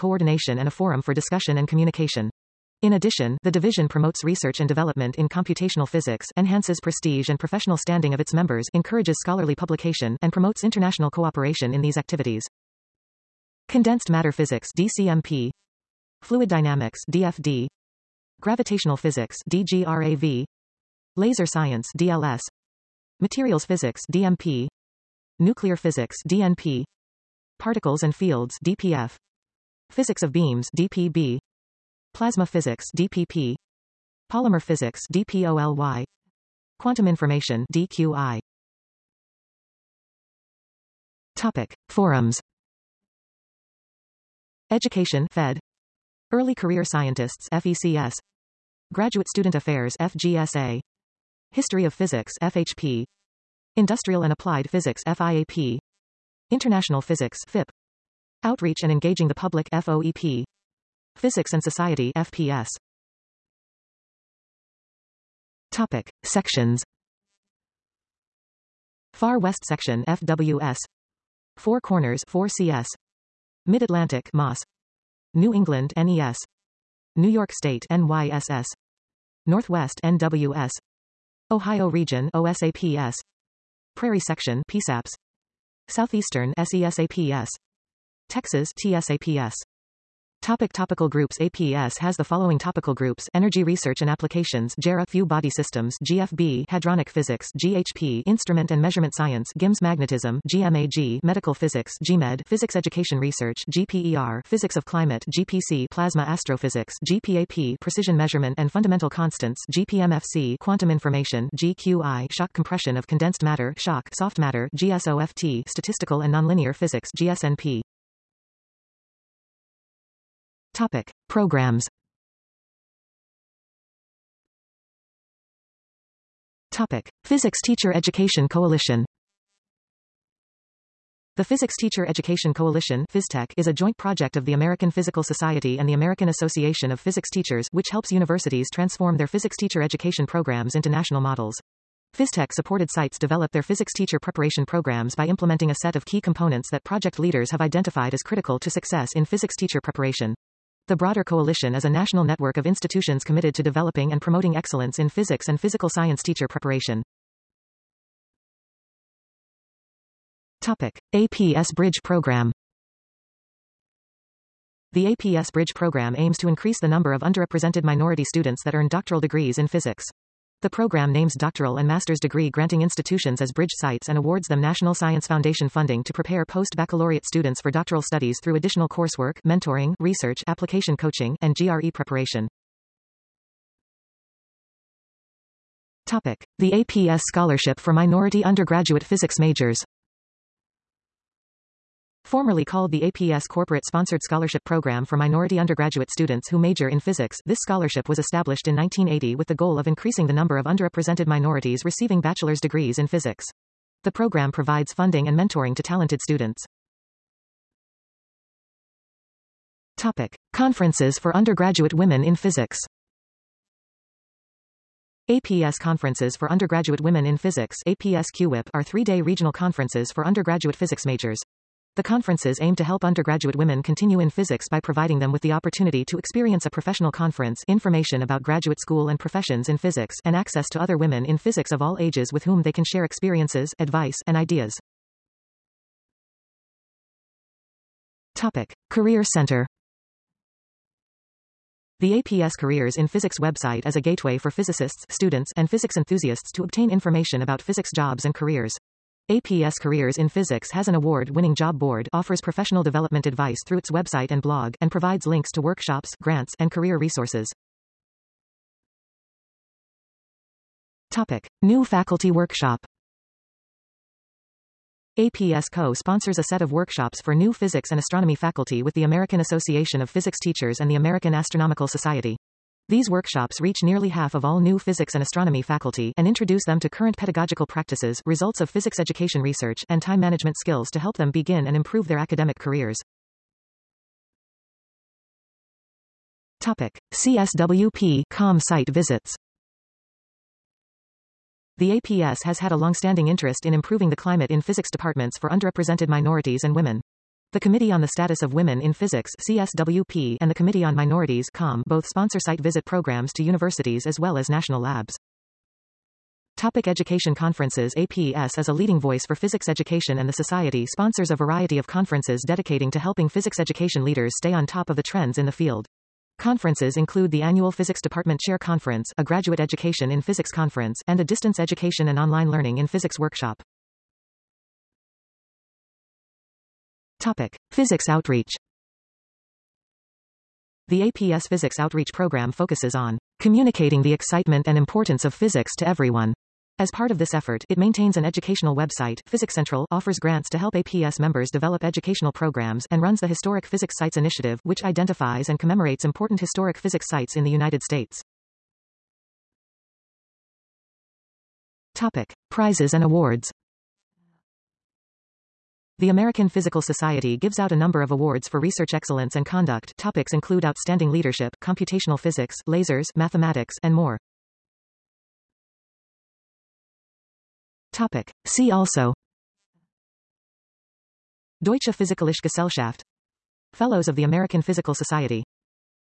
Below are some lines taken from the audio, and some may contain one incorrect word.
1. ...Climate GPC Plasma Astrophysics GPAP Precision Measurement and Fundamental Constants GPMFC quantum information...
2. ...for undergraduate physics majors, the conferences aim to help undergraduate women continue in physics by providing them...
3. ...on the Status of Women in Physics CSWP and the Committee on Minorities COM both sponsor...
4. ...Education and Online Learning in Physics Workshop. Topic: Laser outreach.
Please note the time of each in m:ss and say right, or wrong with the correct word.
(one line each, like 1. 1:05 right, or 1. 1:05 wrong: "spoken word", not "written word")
1. 1:44 right
2. 3:40 right
3. 4:57 right
4. 5:21 wrong: "Physics", not "Laser".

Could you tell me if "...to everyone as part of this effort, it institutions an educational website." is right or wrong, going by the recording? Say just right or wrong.
wrong.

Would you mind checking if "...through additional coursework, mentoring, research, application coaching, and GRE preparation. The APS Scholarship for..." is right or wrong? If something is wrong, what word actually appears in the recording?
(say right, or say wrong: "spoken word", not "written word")
right.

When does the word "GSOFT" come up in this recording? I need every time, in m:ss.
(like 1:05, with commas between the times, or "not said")
1:54.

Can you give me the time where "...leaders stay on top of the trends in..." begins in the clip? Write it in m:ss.
5:14.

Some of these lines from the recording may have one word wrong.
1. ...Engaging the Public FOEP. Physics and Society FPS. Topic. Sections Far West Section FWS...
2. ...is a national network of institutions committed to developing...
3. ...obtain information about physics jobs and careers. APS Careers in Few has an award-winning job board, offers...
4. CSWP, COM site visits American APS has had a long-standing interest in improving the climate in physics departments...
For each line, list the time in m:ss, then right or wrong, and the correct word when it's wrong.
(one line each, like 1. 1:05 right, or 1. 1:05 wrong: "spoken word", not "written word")
1. 0:58 right
2. 2:31 right
3. 4:06 wrong: "Physics", not "Few"
4. 4:47 wrong: "The", not "American".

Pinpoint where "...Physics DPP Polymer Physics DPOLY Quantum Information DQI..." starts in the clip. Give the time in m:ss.
0:32.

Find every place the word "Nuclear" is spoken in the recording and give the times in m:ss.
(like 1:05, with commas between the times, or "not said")
0:25.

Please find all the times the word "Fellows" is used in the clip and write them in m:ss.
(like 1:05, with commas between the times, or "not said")
6:13.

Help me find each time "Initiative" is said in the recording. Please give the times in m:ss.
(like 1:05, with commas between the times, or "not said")
5:44.